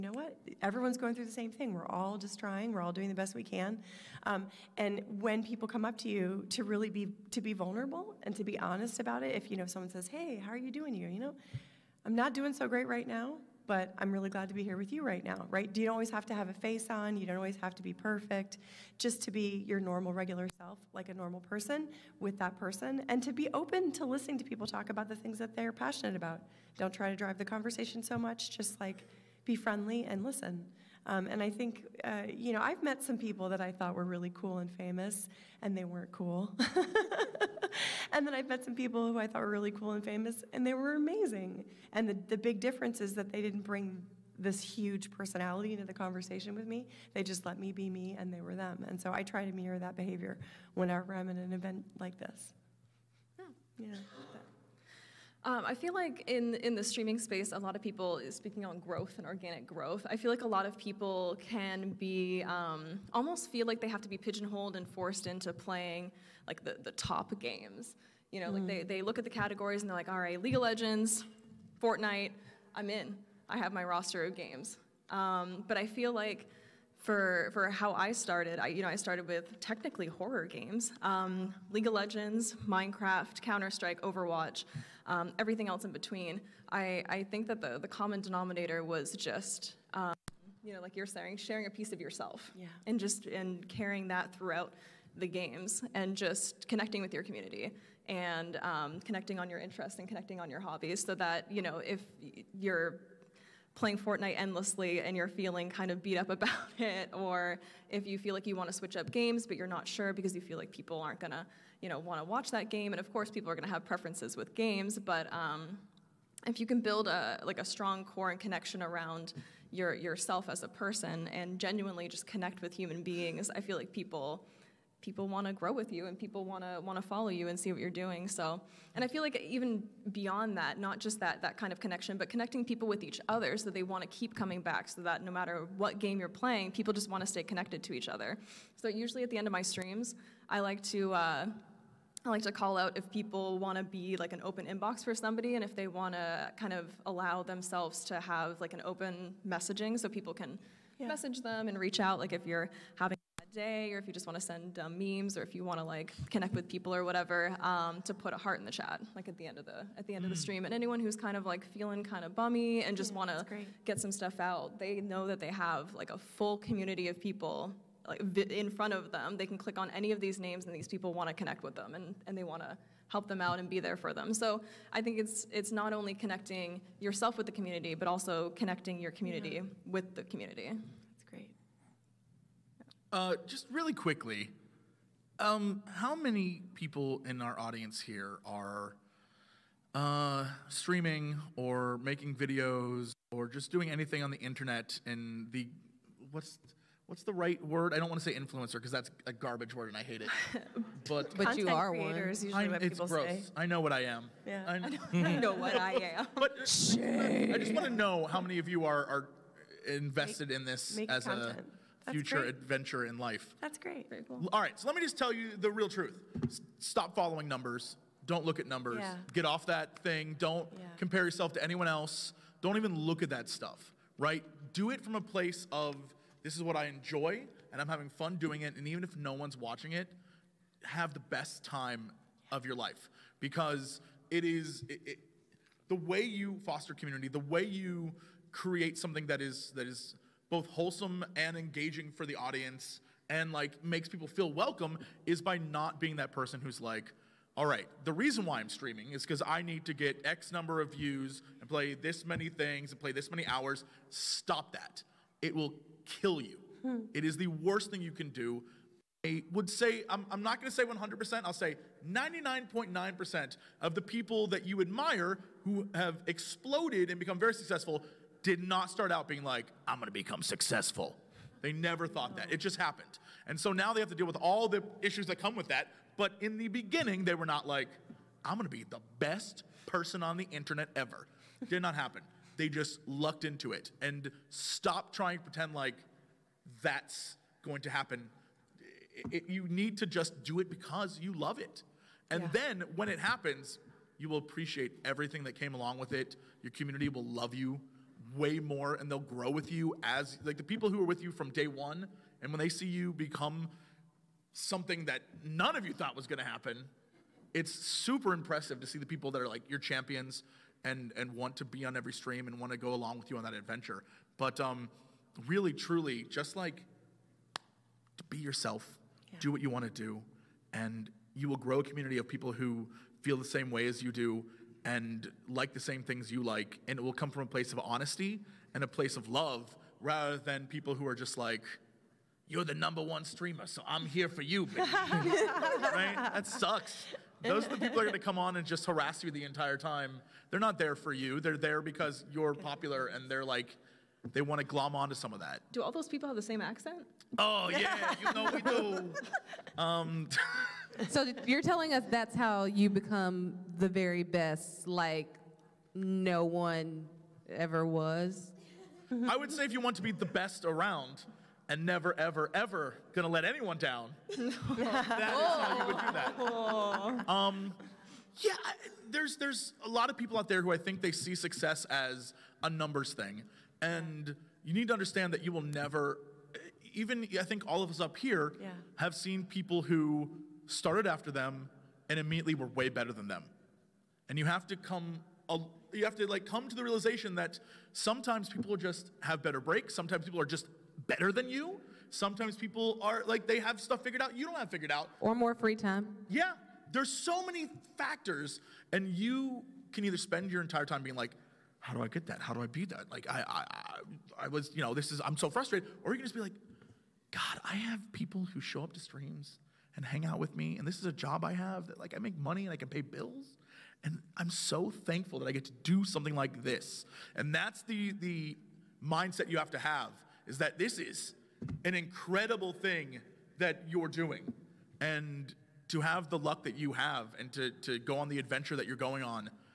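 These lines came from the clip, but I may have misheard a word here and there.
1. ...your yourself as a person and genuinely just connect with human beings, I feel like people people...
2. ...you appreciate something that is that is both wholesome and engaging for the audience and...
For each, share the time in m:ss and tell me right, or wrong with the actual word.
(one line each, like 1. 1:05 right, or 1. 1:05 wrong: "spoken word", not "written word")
1. 1:59 right
2. 3:57 wrong: "create", not "appreciate".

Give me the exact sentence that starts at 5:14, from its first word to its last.
But um, really, truly, just like be yourself, yeah.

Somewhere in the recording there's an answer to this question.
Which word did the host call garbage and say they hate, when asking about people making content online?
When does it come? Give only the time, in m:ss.
3:18.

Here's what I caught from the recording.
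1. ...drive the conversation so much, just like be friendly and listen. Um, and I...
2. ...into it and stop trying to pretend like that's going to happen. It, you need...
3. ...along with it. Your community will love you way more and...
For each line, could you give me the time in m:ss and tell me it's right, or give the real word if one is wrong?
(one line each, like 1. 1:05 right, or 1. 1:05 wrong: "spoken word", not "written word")
1. 0:27 right
2. 4:43 right
3. 4:55 right.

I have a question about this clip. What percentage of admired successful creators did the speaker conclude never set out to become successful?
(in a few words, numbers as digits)
99.9%.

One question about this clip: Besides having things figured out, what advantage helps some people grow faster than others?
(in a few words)
more free time.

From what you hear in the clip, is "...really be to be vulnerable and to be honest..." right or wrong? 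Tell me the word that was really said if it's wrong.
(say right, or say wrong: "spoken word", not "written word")
right.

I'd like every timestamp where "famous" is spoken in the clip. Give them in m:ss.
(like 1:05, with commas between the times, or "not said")
0:34, 0:40.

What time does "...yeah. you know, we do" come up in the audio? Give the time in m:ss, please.
5:47.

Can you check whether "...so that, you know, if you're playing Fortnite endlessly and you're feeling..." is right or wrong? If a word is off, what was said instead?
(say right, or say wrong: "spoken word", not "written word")
right.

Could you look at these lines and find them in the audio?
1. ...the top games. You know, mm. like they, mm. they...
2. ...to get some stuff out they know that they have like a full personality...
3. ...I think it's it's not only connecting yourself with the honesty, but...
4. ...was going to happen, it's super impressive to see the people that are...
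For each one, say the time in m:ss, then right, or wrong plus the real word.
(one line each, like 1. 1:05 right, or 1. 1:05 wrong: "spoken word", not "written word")
1. 1:06 right
2. 2:43 wrong: "community", not "personality"
3. 2:54 wrong: "community", not "honesty"
4. 5:06 right.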